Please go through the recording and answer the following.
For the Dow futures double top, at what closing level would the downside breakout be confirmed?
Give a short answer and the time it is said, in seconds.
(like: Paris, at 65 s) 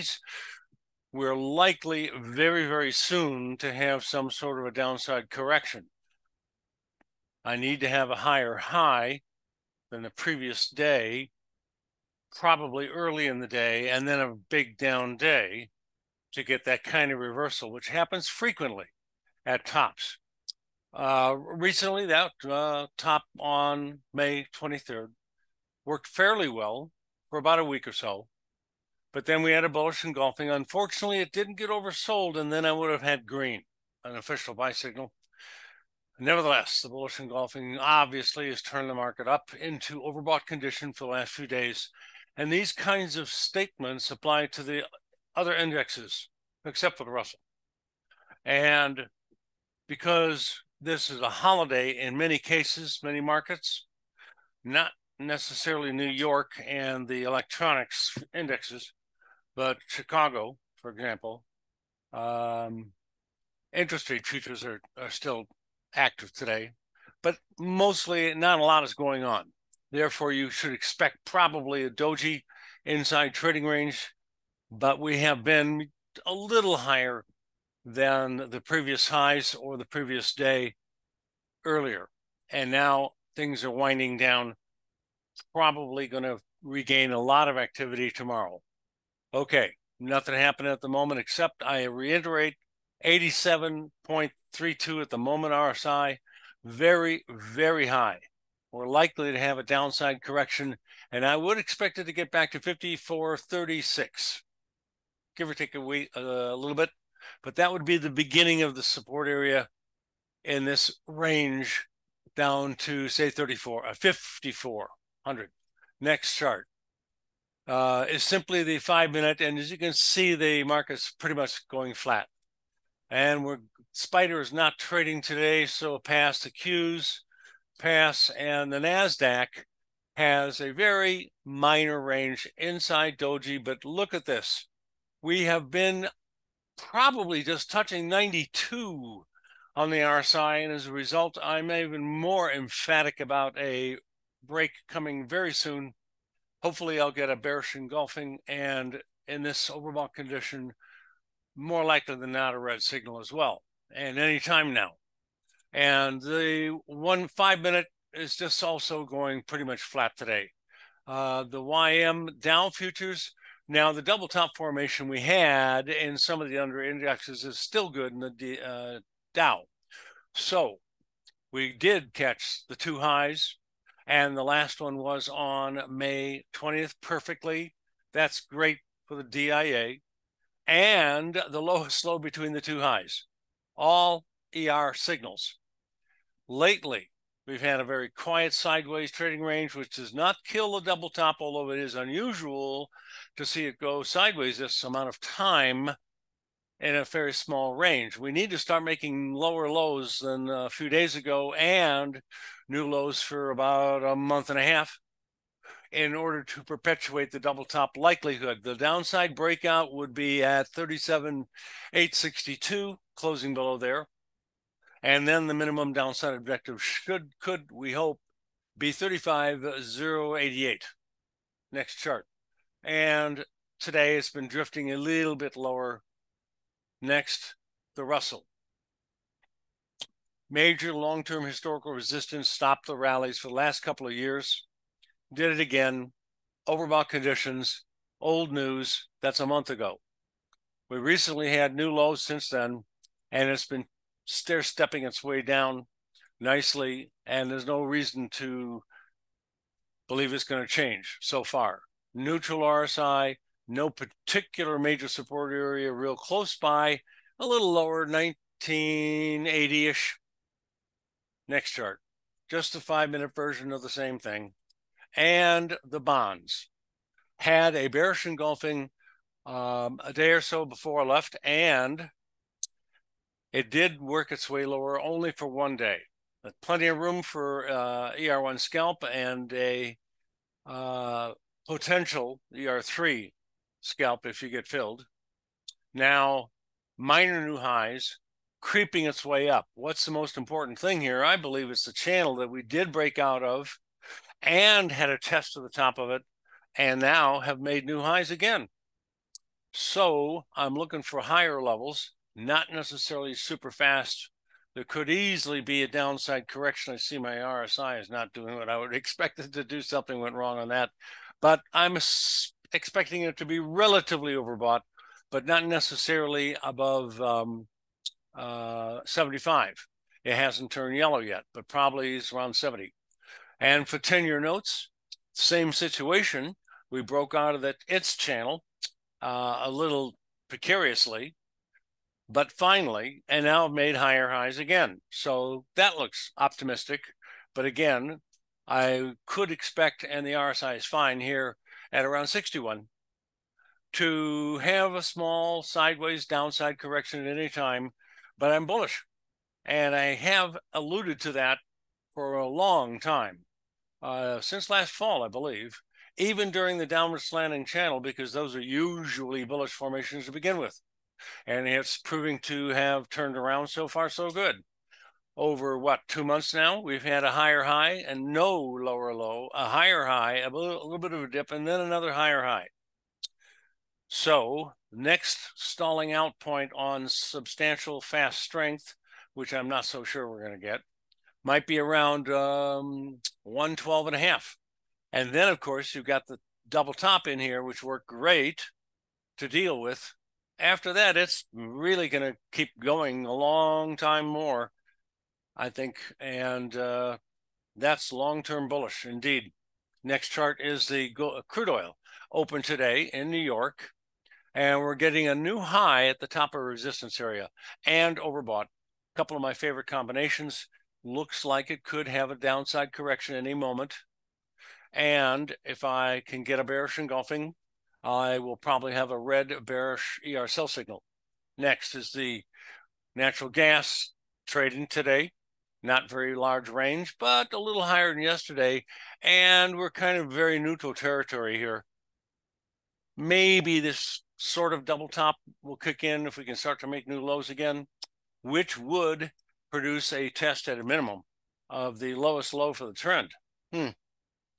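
37,862, at 210 s.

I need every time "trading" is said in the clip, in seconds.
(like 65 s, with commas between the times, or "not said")
73 s, 124 s, 189 s, 424 s.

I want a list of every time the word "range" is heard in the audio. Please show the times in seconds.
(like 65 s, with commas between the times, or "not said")
73 s, 111 s, 132 s, 189 s, 197 s, 426 s.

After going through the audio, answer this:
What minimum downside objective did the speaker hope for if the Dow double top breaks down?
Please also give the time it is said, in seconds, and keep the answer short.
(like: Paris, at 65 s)
35,088, at 218 s.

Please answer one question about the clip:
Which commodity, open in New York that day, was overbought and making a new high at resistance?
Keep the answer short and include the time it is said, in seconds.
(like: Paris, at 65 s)
Crude oil, at 401 s.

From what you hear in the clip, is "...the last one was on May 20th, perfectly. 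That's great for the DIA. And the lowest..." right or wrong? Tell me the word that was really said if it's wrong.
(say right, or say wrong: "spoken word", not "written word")
right.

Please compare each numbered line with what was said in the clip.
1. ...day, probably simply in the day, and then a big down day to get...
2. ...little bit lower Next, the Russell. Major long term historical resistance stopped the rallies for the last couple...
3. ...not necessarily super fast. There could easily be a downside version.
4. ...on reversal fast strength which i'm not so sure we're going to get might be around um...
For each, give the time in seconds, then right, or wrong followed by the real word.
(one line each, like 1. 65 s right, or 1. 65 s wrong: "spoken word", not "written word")
1. 10 s wrong: "early", not "simply"
2. 224 s right
3. 302 s wrong: "correction", not "version"
4. 376 s wrong: "substantial", not "reversal".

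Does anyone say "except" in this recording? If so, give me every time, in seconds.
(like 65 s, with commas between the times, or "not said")
46 s, 91 s.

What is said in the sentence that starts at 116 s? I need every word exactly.
Next chart uh, is simply the five minute.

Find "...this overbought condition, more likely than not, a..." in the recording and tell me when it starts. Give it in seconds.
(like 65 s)
149 s.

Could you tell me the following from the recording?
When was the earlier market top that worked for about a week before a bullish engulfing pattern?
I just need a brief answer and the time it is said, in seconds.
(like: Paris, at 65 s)
May 23rd, at 24 s.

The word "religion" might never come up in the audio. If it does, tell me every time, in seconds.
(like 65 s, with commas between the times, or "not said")
not said.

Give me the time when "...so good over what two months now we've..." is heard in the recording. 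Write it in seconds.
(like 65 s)
364 s.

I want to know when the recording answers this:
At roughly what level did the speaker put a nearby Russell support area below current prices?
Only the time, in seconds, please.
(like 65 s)
258 s.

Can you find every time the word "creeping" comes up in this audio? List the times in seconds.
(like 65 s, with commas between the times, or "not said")
288 s.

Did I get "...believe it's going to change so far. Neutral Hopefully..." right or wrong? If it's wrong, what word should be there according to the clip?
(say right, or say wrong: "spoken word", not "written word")
wrong: "RSI", not "Hopefully".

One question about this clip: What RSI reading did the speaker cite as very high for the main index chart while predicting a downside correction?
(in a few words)
87.32.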